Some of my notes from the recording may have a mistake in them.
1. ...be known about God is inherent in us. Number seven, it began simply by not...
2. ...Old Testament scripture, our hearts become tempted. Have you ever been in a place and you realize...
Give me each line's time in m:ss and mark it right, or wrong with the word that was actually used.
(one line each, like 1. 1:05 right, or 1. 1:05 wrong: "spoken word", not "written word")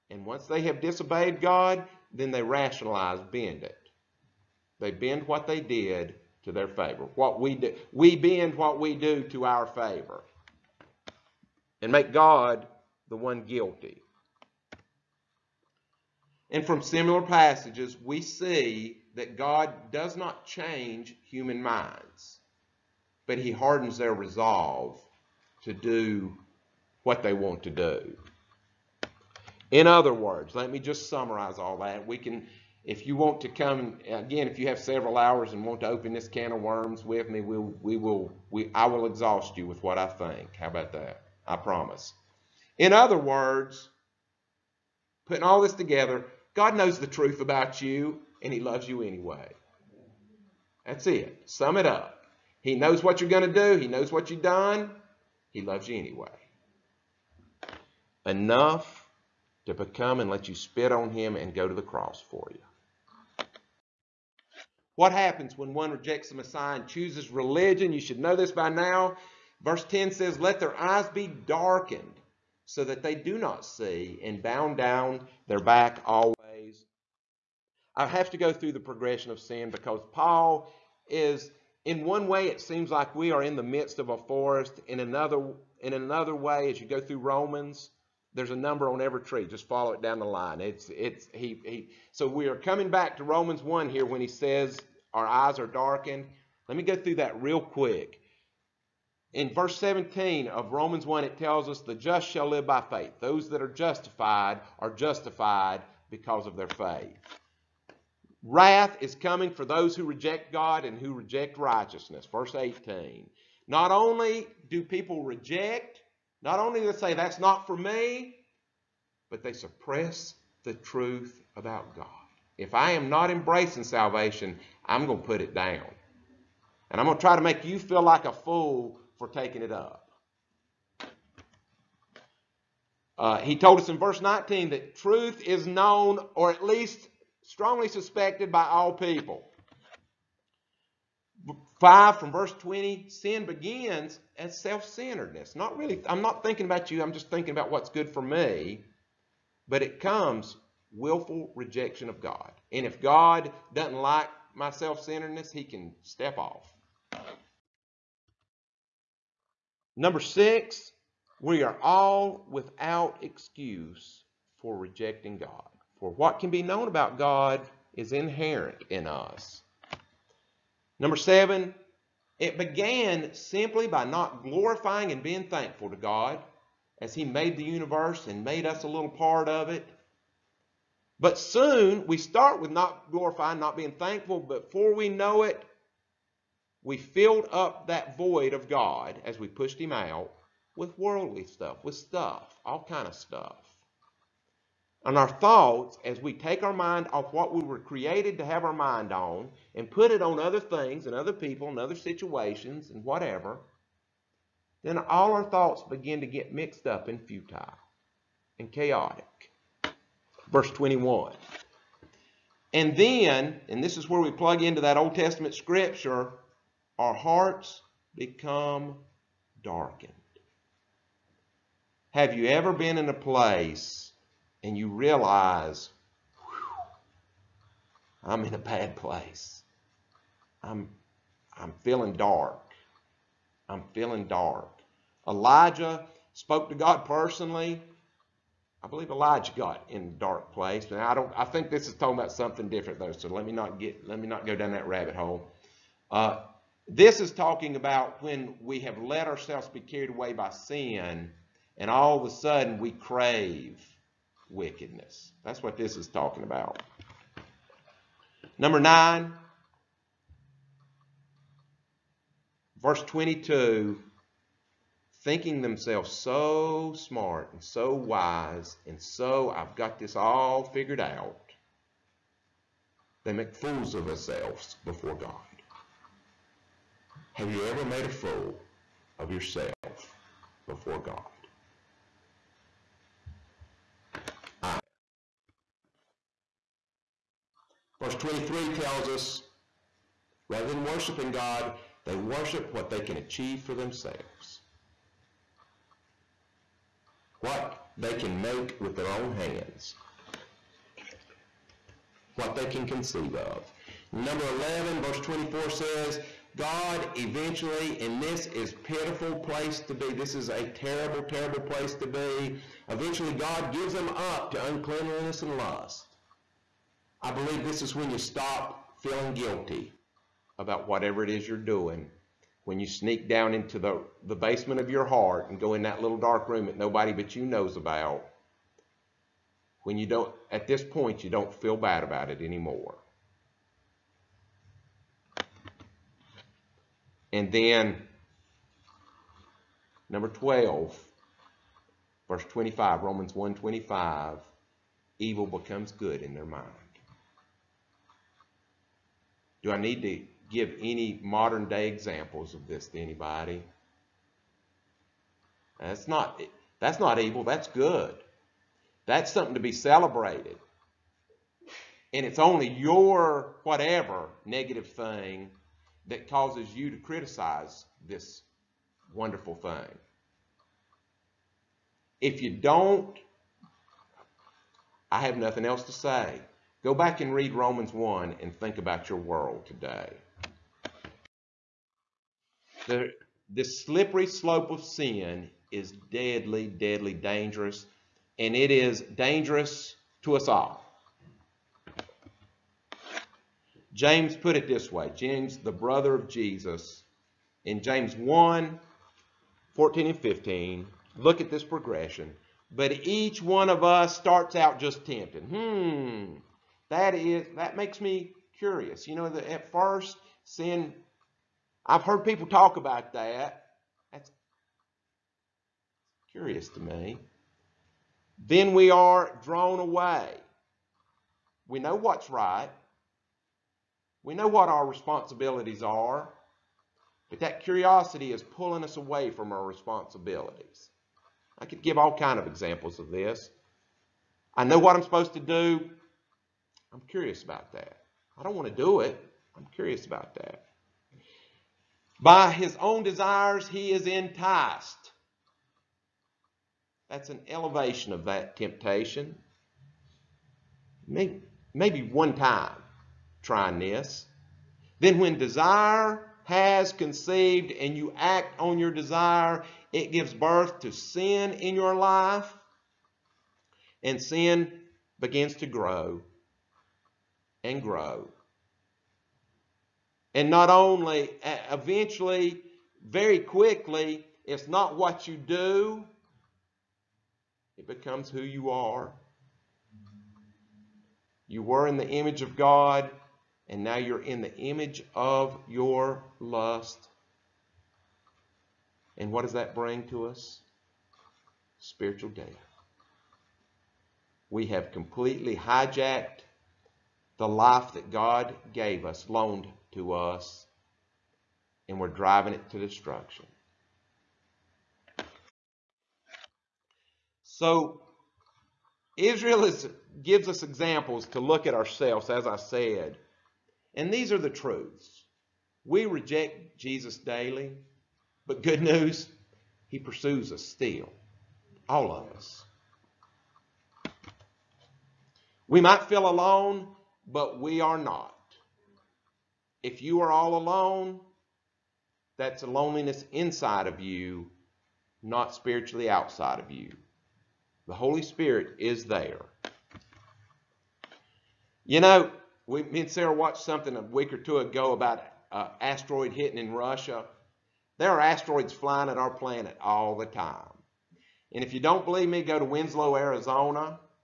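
1. 2:46 right
2. 3:34 wrong: "darkened", not "tempted".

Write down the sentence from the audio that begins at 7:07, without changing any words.
But that curiosity is pulling us away from our responsibilities.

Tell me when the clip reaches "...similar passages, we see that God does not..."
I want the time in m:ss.
0:16.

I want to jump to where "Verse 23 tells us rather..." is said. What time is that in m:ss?
4:48.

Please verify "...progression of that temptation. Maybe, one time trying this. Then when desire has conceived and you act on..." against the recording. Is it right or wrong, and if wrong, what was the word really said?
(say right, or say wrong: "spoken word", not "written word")
wrong: "elevation", not "progression".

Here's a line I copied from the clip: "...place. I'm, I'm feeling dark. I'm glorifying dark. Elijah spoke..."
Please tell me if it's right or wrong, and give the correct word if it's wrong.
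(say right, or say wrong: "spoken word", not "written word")
wrong: "feeling", not "glorifying".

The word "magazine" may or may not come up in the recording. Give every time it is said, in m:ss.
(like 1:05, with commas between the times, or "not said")
not said.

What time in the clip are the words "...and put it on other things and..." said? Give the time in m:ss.
3:19.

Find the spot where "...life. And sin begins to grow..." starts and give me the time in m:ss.
7:41.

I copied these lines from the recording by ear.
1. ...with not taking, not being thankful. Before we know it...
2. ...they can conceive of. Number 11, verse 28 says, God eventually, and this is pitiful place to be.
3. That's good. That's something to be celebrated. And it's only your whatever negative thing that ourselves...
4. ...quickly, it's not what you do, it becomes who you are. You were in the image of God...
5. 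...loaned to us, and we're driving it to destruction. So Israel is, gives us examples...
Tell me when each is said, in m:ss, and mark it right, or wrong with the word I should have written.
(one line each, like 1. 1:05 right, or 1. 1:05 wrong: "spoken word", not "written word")
1. 3:02 wrong: "glorifying", not "taking"
2. 5:02 wrong: "24", not "28"
3. 5:57 wrong: "causes", not "ourselves"
4. 7:53 right
5. 8:19 right.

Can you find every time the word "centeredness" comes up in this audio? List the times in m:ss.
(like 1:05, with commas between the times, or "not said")
2:24, 2:34.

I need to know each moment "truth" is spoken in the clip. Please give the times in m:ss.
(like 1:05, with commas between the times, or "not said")
0:47, 2:00, 2:14, 8:34.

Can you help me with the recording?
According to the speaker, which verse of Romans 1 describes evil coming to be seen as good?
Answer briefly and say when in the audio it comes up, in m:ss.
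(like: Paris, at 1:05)
25, at 5:42.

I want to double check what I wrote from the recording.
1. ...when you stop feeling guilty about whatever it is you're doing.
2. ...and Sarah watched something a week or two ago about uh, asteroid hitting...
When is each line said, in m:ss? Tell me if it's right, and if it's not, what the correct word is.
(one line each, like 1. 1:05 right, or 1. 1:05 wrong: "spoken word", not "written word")
1. 5:17 right
2. 9:03 right.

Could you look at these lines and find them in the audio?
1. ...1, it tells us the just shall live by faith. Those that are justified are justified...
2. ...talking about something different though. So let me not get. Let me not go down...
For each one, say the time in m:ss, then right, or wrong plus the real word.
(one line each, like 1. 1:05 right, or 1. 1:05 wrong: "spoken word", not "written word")
1. 1:41 right
2. 4:01 right.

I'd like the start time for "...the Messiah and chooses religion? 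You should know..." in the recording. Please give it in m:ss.
1:06.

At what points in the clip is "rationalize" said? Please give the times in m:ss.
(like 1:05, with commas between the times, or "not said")
0:02.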